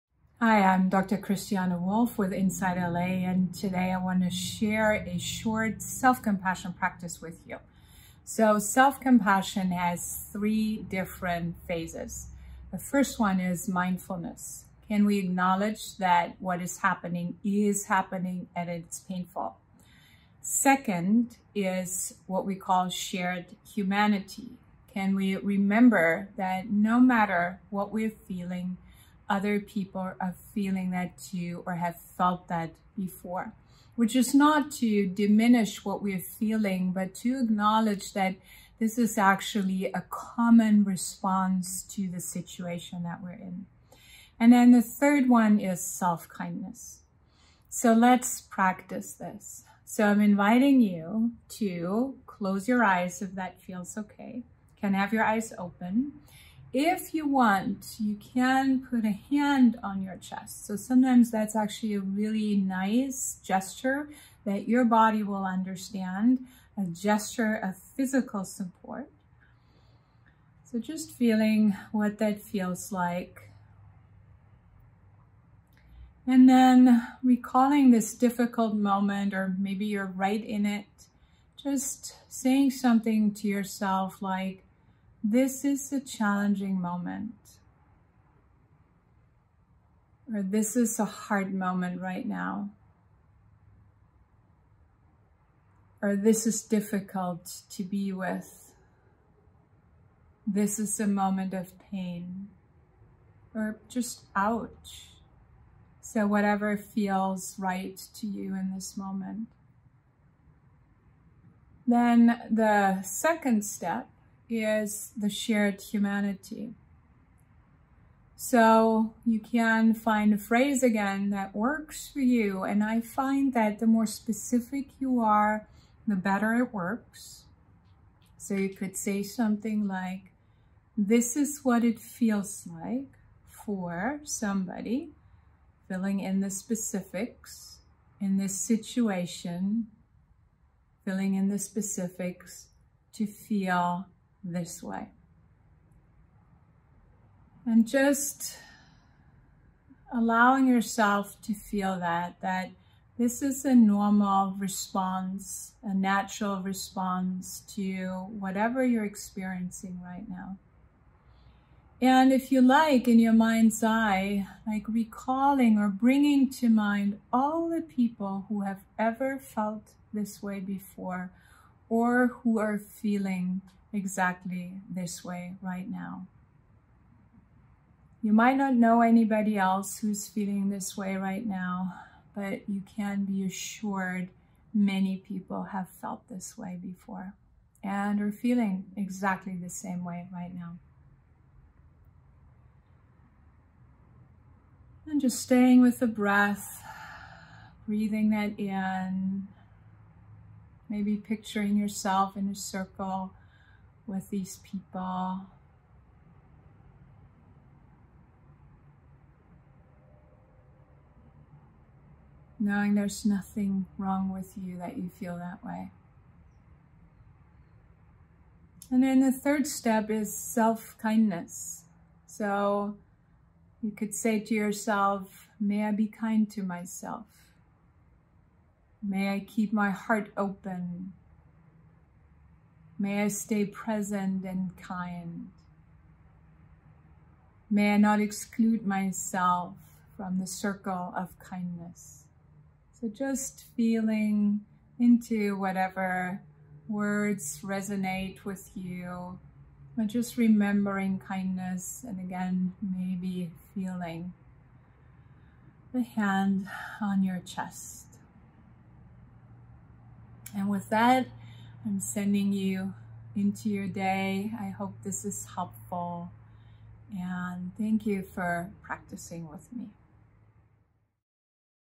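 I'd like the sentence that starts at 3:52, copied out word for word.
May I stay present and kind.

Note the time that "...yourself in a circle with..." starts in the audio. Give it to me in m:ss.
3:21.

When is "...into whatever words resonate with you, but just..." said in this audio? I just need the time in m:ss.
4:04.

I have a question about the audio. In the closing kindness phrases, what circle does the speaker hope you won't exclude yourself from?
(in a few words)
the circle of kindness.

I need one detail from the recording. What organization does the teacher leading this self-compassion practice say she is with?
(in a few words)
InsightLA.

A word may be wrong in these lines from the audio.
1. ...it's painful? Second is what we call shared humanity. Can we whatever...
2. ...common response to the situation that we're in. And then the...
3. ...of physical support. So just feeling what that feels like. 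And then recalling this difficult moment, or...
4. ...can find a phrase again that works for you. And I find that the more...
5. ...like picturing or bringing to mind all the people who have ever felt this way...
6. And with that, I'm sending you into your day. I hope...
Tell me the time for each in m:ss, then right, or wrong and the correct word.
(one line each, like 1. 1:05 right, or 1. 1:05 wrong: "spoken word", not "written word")
1. 0:18 wrong: "remember", not "whatever"
2. 0:40 right
3. 1:07 right
4. 1:59 right
5. 2:44 wrong: "recalling", not "picturing"
6. 4:20 right.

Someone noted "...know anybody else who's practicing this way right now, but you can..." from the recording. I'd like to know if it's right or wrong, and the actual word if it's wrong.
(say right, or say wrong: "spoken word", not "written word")
wrong: "feeling", not "practicing".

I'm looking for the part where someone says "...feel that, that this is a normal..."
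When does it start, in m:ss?
2:31.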